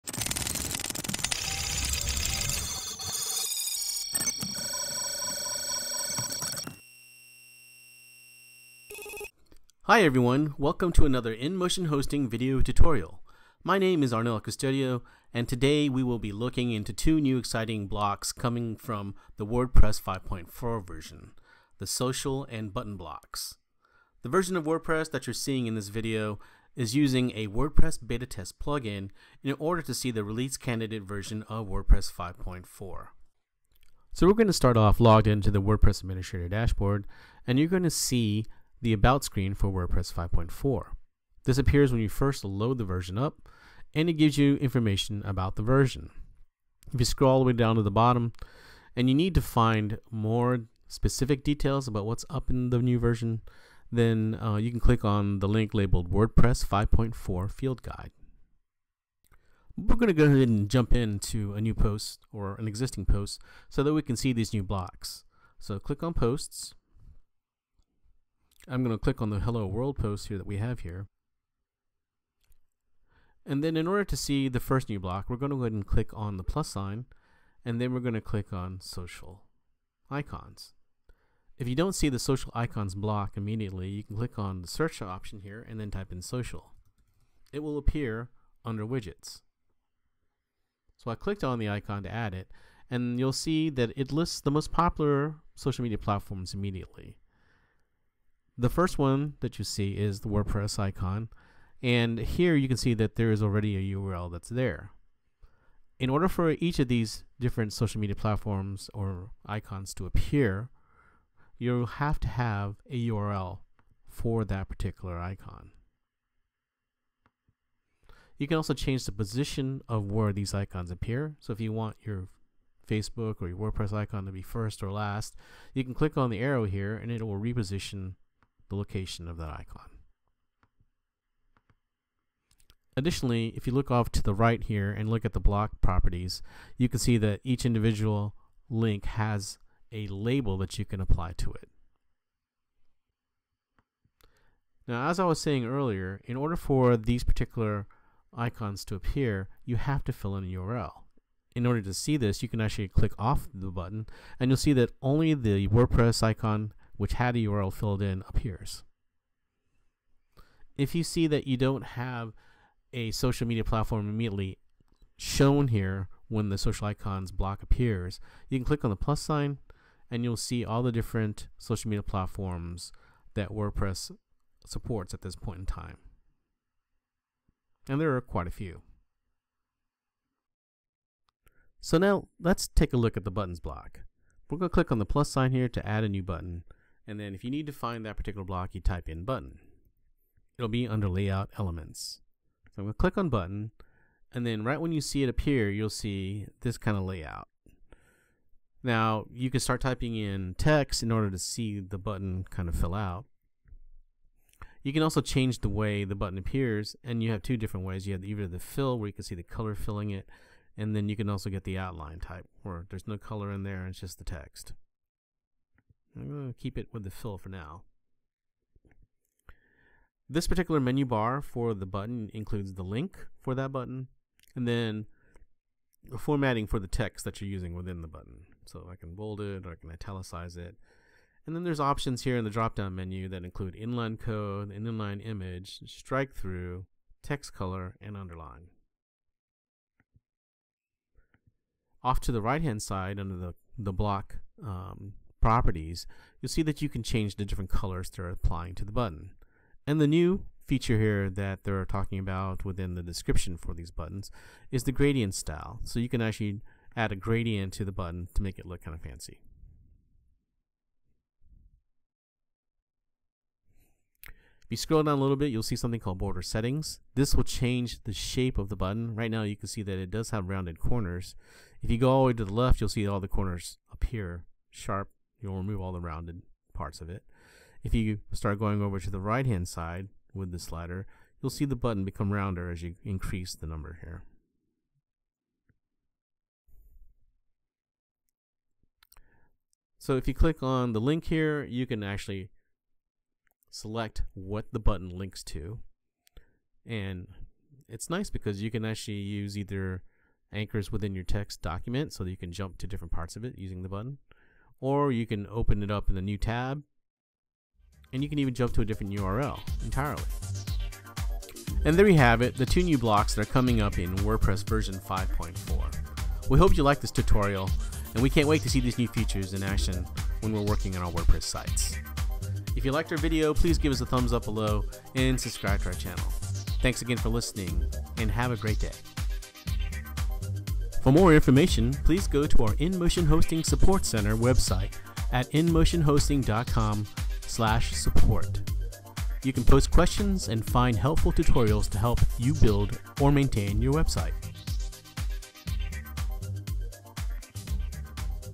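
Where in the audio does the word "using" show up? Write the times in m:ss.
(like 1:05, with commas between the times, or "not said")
0:26, 3:47, 5:03.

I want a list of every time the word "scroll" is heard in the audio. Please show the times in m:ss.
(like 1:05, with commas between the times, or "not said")
0:47, 4:24.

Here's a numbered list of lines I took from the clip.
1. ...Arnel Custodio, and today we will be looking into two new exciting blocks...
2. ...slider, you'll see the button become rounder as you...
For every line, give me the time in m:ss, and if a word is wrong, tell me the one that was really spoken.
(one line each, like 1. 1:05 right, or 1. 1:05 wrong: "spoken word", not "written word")
1. 0:14 right
2. 4:40 right.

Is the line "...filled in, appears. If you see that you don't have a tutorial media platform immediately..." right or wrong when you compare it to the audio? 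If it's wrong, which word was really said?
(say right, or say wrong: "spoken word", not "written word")
wrong: "social", not "tutorial".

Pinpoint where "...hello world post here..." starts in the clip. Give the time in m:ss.
1:09.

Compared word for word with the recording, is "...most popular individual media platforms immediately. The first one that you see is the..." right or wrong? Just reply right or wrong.
wrong.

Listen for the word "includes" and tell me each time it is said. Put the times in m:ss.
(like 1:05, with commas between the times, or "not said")
3:42, 3:53.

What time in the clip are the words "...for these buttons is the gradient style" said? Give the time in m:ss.
4:13.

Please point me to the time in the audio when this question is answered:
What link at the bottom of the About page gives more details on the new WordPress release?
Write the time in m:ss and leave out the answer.
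0:56.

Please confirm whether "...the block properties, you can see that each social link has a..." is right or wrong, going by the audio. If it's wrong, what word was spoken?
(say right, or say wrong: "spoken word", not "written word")
wrong: "individual", not "social".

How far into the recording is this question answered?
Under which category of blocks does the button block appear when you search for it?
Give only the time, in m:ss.
3:11.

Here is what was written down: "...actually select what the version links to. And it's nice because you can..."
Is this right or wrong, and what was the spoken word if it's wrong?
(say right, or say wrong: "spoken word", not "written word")
wrong: "button", not "version".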